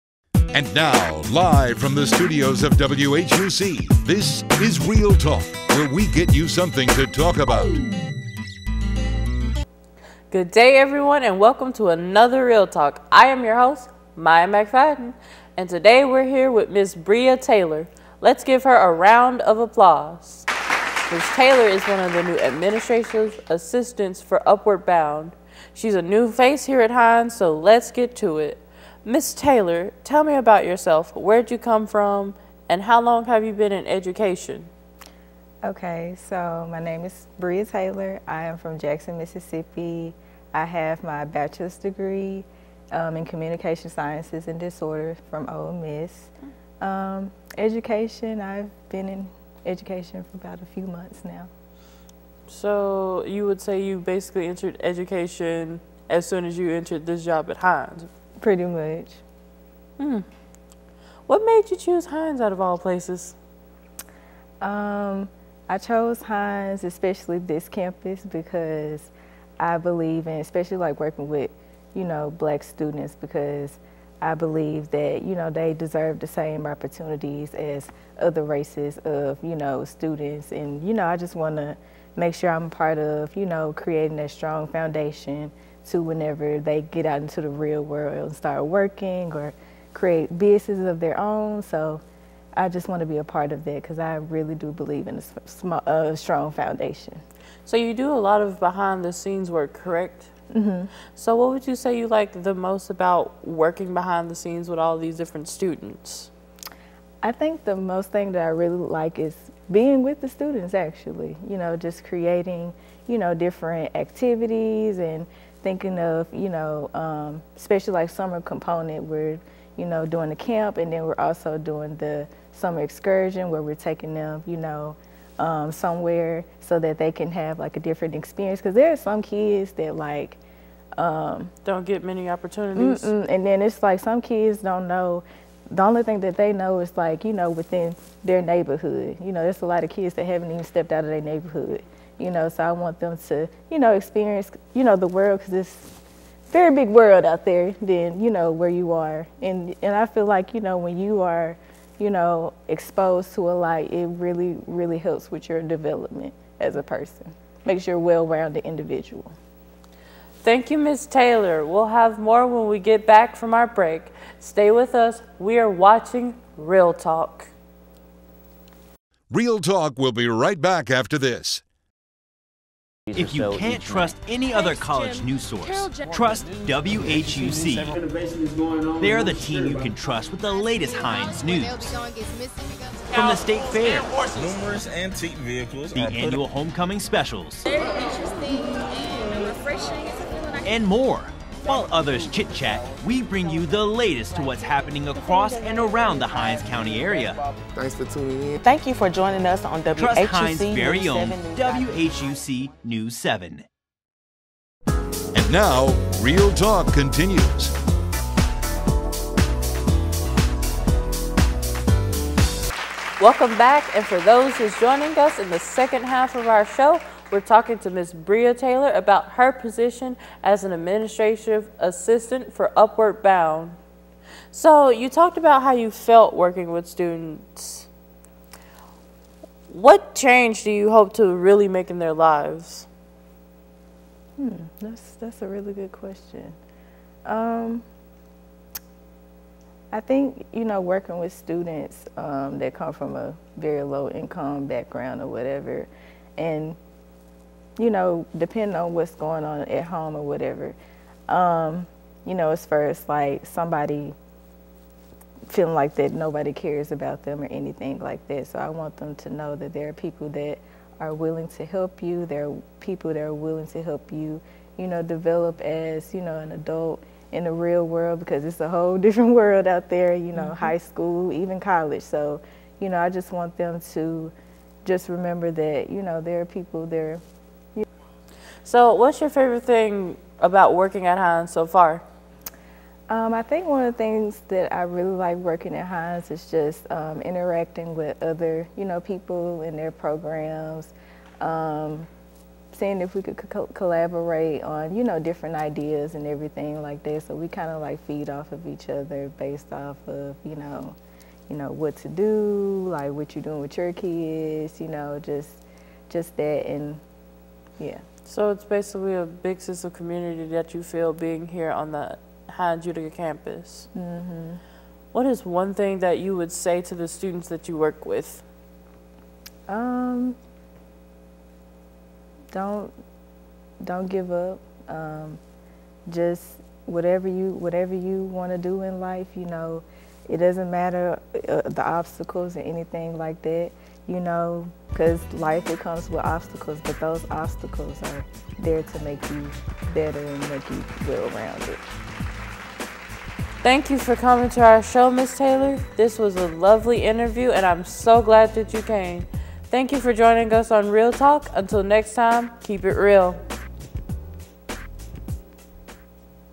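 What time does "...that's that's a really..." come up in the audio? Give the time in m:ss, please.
3:54.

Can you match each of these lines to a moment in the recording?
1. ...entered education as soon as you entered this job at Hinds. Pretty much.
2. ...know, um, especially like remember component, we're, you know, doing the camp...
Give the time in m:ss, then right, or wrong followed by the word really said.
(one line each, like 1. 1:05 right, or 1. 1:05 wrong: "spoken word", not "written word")
1. 0:54 right
2. 1:56 wrong: "summer", not "remember".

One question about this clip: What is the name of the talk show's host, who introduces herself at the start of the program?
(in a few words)
Maya McFadden.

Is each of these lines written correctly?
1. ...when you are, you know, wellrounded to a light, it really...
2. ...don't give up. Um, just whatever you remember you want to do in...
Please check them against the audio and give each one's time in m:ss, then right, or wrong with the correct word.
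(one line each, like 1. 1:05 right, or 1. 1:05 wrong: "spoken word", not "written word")
1. 2:30 wrong: "exposed", not "wellrounded"
2. 5:23 wrong: "whatever", not "remember".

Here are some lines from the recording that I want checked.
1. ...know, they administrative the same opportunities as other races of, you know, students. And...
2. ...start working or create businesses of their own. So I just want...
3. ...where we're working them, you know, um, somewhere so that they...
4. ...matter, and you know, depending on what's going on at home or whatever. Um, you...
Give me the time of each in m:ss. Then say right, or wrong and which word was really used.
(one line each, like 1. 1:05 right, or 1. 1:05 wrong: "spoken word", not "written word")
1. 1:15 wrong: "deserve", not "administrative"
2. 1:28 right
3. 2:03 wrong: "taking", not "working"
4. 4:05 wrong: "whatever", not "matter".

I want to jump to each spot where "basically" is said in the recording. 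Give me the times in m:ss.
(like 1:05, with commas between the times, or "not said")
0:53, 5:08.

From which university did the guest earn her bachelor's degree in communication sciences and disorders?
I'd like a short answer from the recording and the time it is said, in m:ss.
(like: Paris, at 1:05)
Ole Miss, at 0:45.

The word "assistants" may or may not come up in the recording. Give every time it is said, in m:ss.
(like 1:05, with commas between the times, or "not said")
0:23, 3:41.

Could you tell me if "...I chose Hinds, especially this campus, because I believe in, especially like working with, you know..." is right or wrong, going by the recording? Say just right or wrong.
right.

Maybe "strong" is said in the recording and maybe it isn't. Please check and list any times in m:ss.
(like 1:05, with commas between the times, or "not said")
1:24, 1:36.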